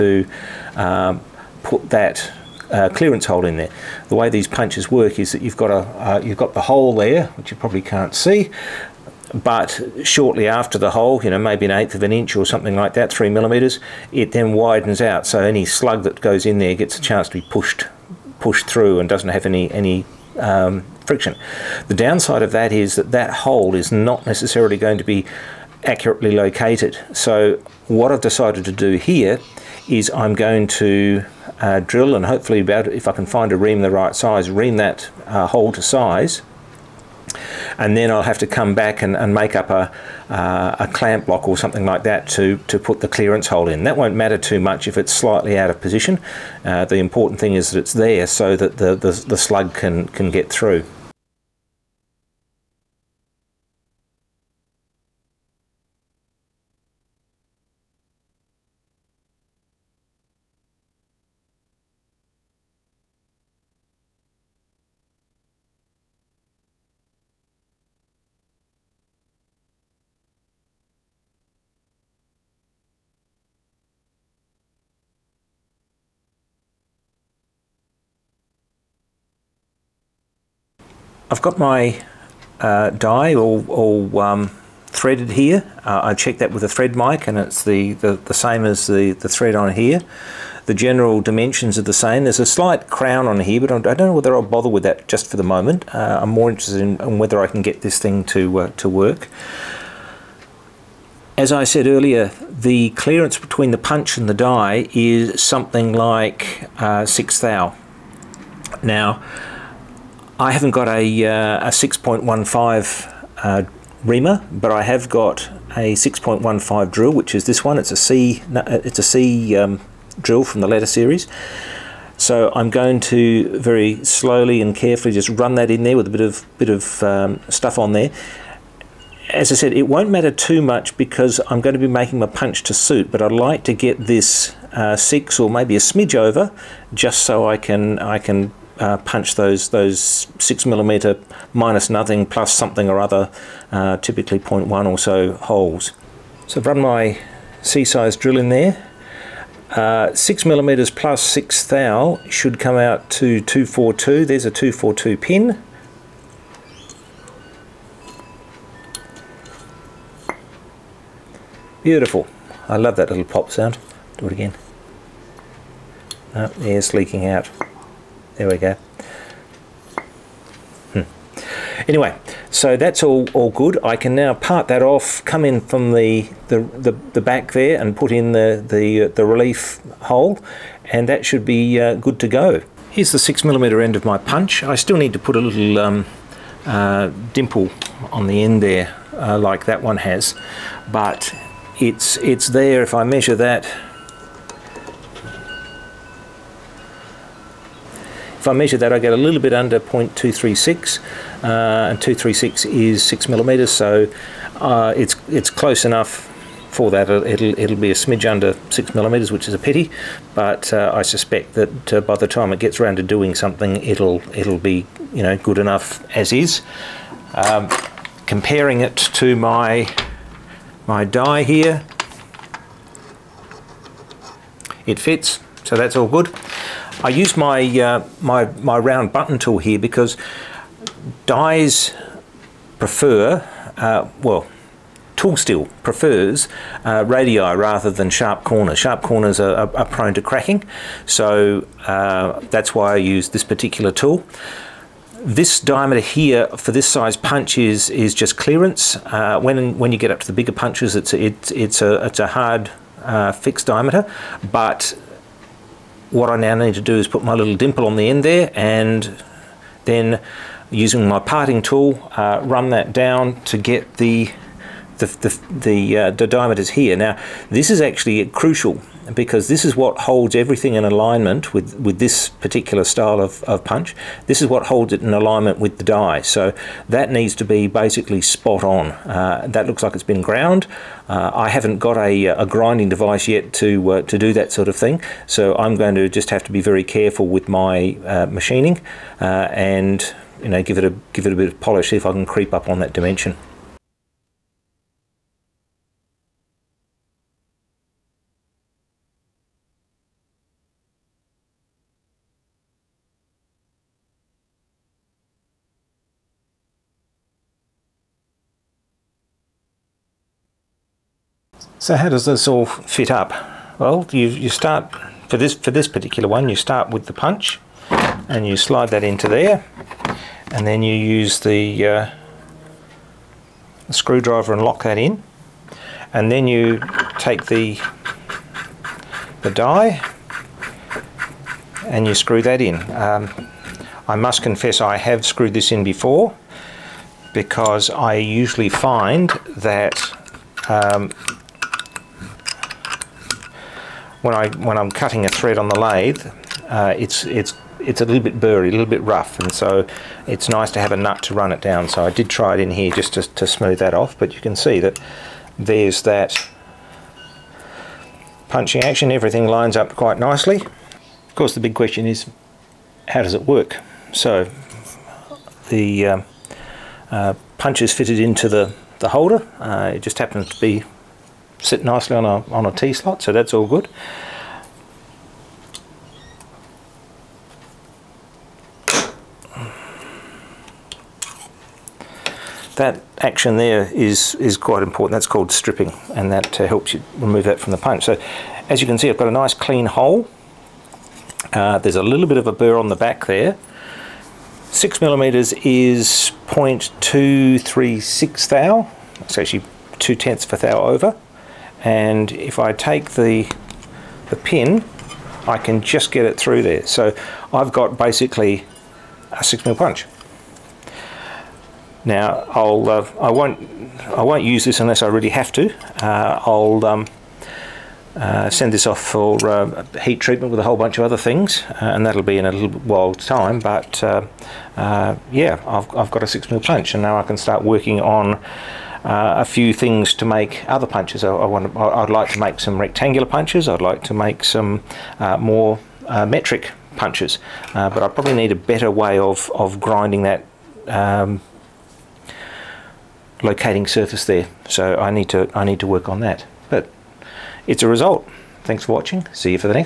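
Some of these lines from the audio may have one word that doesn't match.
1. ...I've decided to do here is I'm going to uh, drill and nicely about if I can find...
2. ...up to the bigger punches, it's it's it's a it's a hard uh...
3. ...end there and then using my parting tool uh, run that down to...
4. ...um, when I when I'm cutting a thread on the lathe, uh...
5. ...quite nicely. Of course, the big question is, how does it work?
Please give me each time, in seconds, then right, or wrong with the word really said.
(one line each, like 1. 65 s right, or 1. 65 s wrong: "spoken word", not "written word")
1. 28 s wrong: "hopefully", not "nicely"
2. 250 s right
3. 258 s right
4. 340 s right
5. 359 s right.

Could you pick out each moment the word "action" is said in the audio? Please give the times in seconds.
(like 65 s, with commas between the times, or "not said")
358 s, 383 s.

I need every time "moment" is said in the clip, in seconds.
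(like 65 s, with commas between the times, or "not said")
95 s.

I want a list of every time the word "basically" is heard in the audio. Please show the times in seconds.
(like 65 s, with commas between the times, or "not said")
277 s, 407 s.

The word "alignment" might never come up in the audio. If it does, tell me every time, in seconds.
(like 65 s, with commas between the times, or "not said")
270 s, 275 s.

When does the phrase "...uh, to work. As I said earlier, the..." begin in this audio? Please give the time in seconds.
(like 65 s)
98 s.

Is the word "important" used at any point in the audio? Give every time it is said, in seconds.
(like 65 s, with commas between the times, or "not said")
46 s, 384 s.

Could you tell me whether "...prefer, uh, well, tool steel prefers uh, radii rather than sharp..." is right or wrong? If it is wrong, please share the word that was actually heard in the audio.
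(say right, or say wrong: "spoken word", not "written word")
right.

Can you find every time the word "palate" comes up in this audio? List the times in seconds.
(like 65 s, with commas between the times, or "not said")
not said.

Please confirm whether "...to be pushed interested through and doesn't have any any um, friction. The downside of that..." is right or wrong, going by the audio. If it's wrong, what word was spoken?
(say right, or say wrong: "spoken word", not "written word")
wrong: "pushed", not "interested".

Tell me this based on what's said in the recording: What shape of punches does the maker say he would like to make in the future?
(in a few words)
rectangular.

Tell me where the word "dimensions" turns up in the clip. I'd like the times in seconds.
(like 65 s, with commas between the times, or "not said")
91 s, 292 s.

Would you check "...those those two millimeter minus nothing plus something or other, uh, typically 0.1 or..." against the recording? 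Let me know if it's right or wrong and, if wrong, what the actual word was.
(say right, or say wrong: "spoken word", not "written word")
wrong: "six", not "two".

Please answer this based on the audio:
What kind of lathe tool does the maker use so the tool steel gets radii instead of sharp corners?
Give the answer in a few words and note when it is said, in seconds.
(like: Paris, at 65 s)
round button tool, at 228 s.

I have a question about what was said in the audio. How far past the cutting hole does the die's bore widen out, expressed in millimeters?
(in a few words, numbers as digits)
3 millimeters.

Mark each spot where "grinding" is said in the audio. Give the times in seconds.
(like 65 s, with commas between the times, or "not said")
282 s, 439 s.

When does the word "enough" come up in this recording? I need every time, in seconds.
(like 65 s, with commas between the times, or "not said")
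205 s, 215 s.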